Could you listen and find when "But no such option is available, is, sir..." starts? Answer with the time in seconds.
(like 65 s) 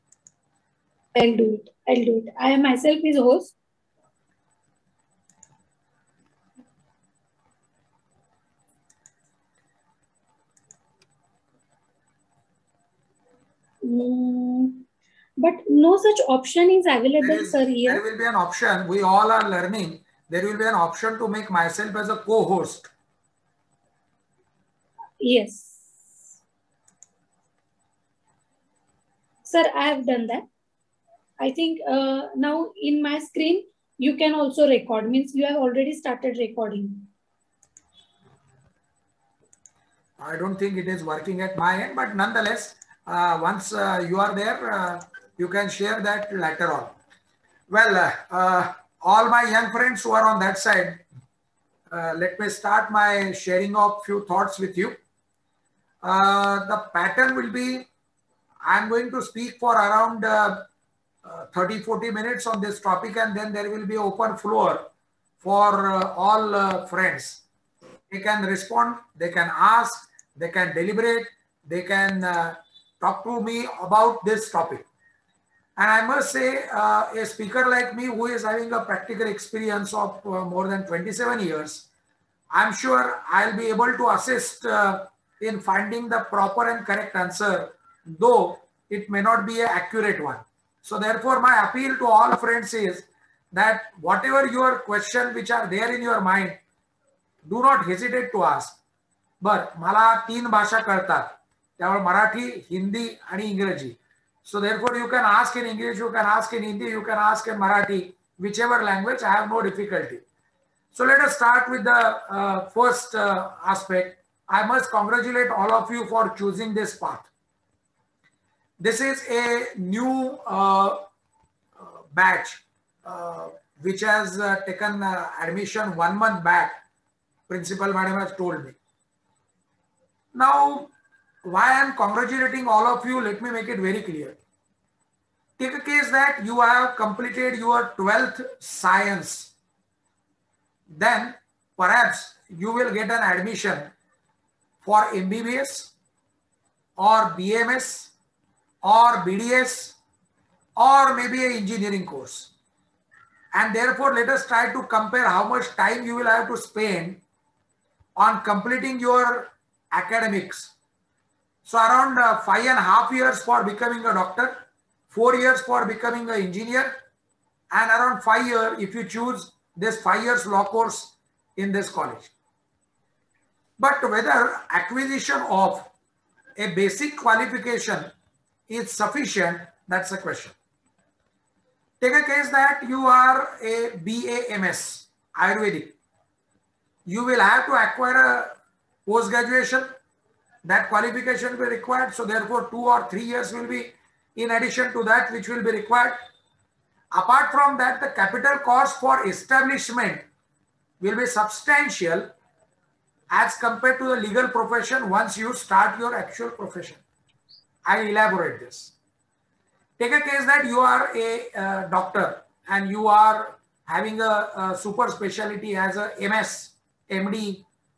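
15 s.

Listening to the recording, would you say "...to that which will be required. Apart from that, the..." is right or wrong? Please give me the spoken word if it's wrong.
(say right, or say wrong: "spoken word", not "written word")
right.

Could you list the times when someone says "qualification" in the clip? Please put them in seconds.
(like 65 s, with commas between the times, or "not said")
177 s, 190 s.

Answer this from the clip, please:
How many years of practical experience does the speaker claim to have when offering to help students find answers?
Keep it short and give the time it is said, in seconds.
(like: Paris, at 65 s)
more than 27 years, at 80 s.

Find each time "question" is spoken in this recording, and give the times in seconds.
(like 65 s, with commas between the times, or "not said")
94 s, 180 s.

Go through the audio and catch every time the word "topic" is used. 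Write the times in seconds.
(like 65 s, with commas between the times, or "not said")
62 s, 74 s.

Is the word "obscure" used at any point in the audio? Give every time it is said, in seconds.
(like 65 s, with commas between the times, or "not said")
not said.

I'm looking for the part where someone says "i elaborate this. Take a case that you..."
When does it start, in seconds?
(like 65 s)
207 s.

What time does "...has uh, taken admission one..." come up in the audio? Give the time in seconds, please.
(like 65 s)
124 s.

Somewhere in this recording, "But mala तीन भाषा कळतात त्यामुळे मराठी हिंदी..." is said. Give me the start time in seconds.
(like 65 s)
99 s.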